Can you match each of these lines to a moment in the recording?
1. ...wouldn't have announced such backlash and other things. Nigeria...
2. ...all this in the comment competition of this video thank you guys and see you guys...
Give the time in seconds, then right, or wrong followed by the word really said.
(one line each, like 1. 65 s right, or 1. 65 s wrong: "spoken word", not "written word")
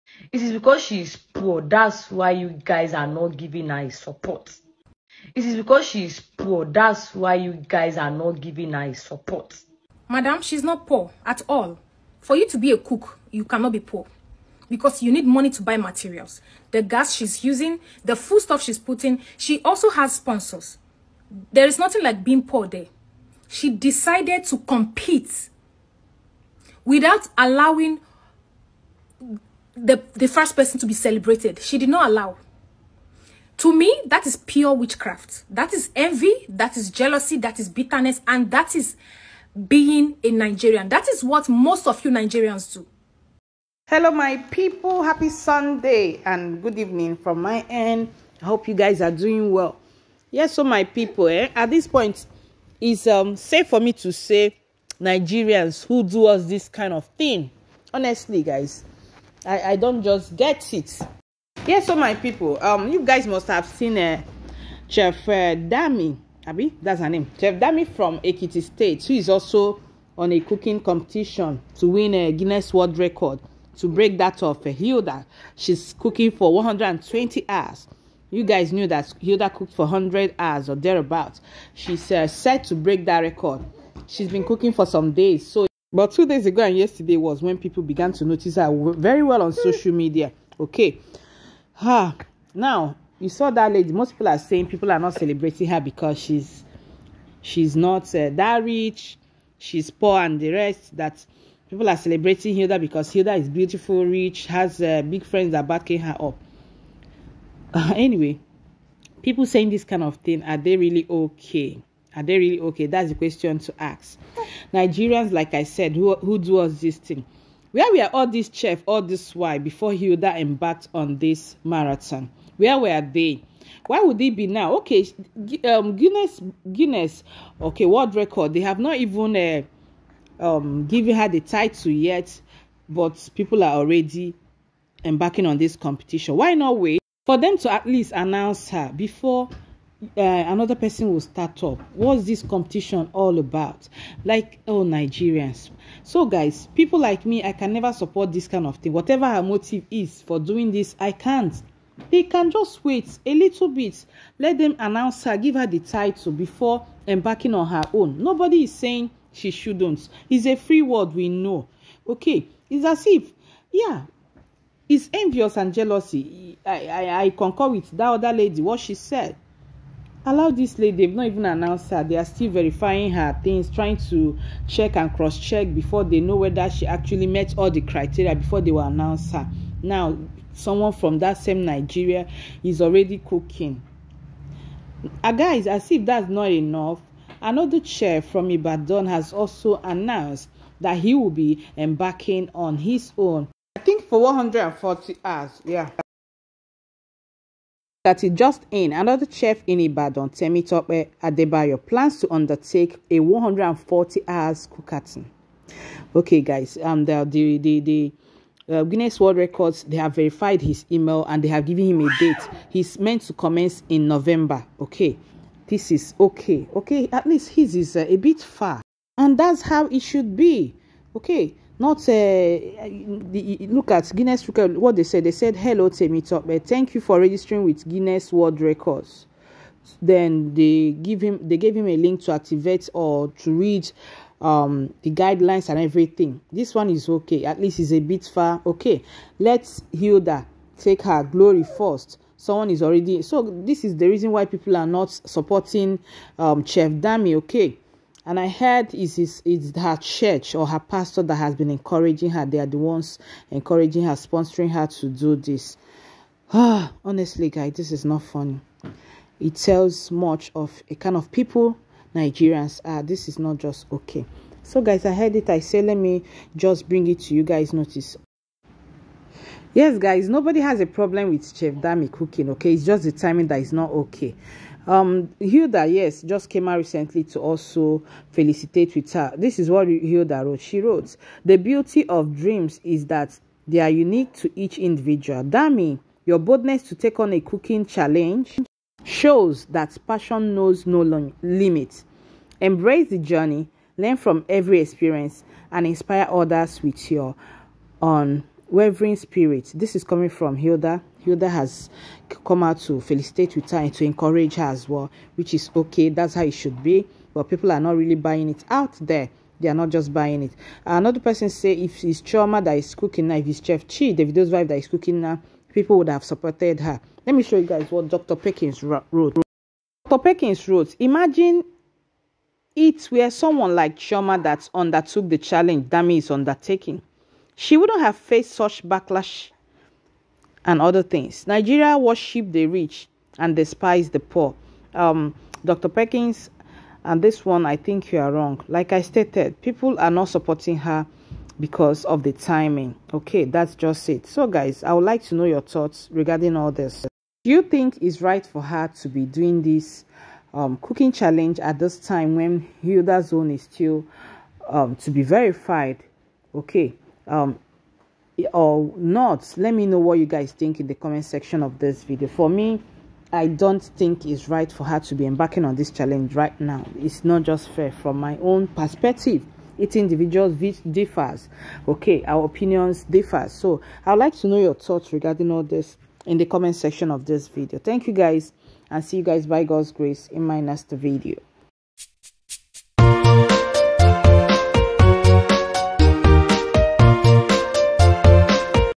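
1. 327 s wrong: "faced", not "announced"
2. 375 s wrong: "section", not "competition".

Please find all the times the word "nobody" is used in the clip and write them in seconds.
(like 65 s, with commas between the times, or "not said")
158 s, 270 s.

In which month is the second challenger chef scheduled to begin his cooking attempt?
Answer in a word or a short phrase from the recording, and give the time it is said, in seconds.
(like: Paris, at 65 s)
November, at 214 s.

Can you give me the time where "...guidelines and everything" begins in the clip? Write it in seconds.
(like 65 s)
235 s.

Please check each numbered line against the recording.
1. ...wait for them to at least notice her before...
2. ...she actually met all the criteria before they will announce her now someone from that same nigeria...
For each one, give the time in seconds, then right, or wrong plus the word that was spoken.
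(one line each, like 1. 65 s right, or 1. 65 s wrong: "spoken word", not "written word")
1. 136 s wrong: "announce", not "notice"
2. 176 s right.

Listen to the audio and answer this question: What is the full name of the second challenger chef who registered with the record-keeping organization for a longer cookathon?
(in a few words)
Temitope Adebayo.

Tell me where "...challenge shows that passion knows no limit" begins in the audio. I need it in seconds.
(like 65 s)
287 s.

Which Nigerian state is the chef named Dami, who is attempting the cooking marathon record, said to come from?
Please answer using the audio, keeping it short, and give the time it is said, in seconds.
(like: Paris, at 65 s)
Ekiti State, at 68 s.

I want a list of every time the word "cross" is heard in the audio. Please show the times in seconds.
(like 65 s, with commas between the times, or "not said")
175 s.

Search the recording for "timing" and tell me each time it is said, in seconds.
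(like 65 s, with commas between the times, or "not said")
273 s, 342 s.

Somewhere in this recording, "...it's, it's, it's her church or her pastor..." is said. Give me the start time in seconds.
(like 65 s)
248 s.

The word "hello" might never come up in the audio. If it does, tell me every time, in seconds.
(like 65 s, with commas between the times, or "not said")
43 s, 225 s.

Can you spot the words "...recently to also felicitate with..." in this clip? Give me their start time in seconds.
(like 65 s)
276 s.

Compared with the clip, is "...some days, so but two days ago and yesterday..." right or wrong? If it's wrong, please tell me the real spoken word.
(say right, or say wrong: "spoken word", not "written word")
right.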